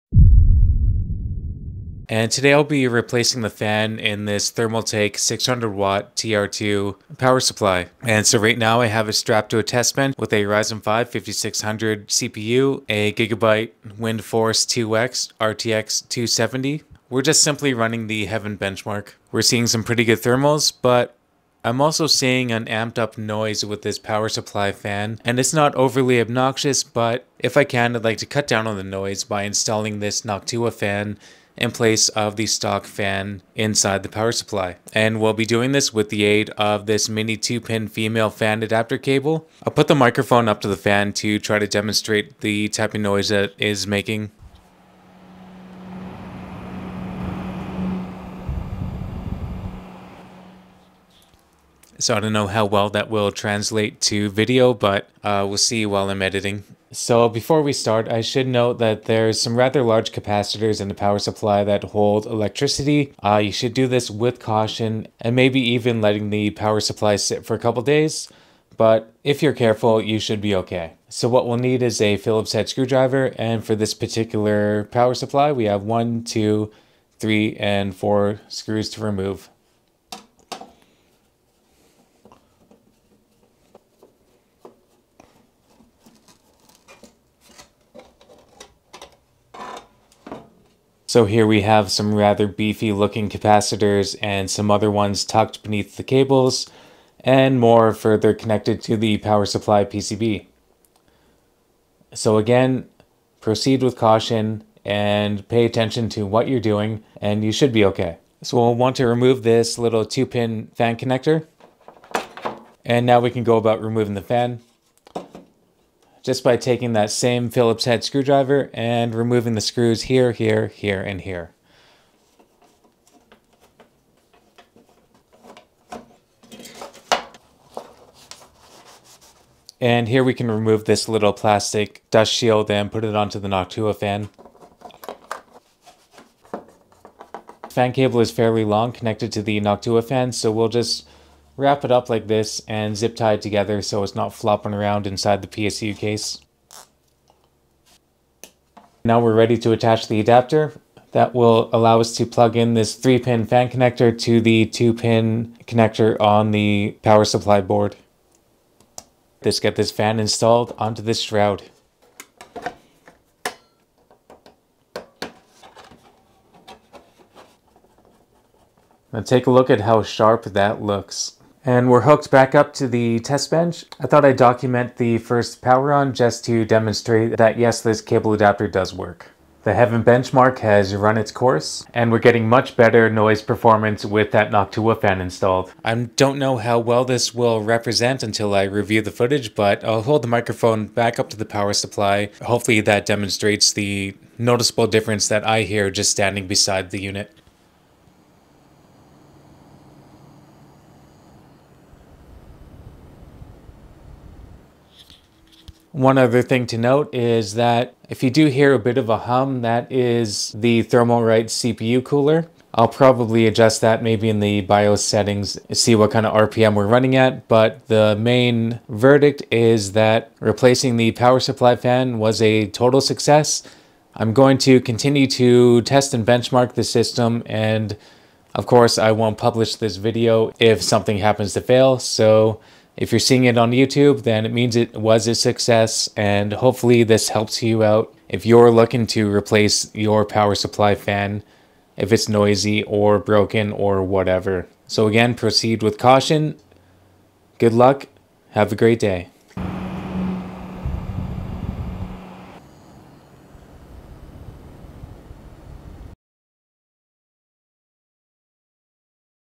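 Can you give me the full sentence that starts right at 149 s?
Now we're ready to attach the adapter.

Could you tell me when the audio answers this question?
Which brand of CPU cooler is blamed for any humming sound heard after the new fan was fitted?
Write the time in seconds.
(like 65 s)
210 s.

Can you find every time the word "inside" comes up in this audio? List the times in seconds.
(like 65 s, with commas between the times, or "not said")
33 s, 145 s.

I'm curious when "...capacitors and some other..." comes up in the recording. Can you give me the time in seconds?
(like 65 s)
93 s.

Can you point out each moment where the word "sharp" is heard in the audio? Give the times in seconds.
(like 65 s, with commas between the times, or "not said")
170 s.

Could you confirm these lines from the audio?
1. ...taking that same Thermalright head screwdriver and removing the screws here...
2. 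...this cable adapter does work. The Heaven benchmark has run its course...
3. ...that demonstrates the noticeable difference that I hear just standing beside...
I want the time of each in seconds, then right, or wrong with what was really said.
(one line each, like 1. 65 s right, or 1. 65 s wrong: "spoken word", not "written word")
1. 116 s wrong: "Phillips", not "Thermalright"
2. 177 s right
3. 192 s right.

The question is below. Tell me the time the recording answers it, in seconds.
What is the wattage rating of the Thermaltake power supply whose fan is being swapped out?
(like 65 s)
5 s.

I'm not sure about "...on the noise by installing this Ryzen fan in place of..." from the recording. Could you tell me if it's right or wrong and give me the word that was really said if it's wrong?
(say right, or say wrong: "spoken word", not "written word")
wrong: "Noctua", not "Ryzen".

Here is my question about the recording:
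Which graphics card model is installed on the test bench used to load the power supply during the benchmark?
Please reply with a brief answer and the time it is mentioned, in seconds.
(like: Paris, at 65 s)
RTX 2070, at 15 s.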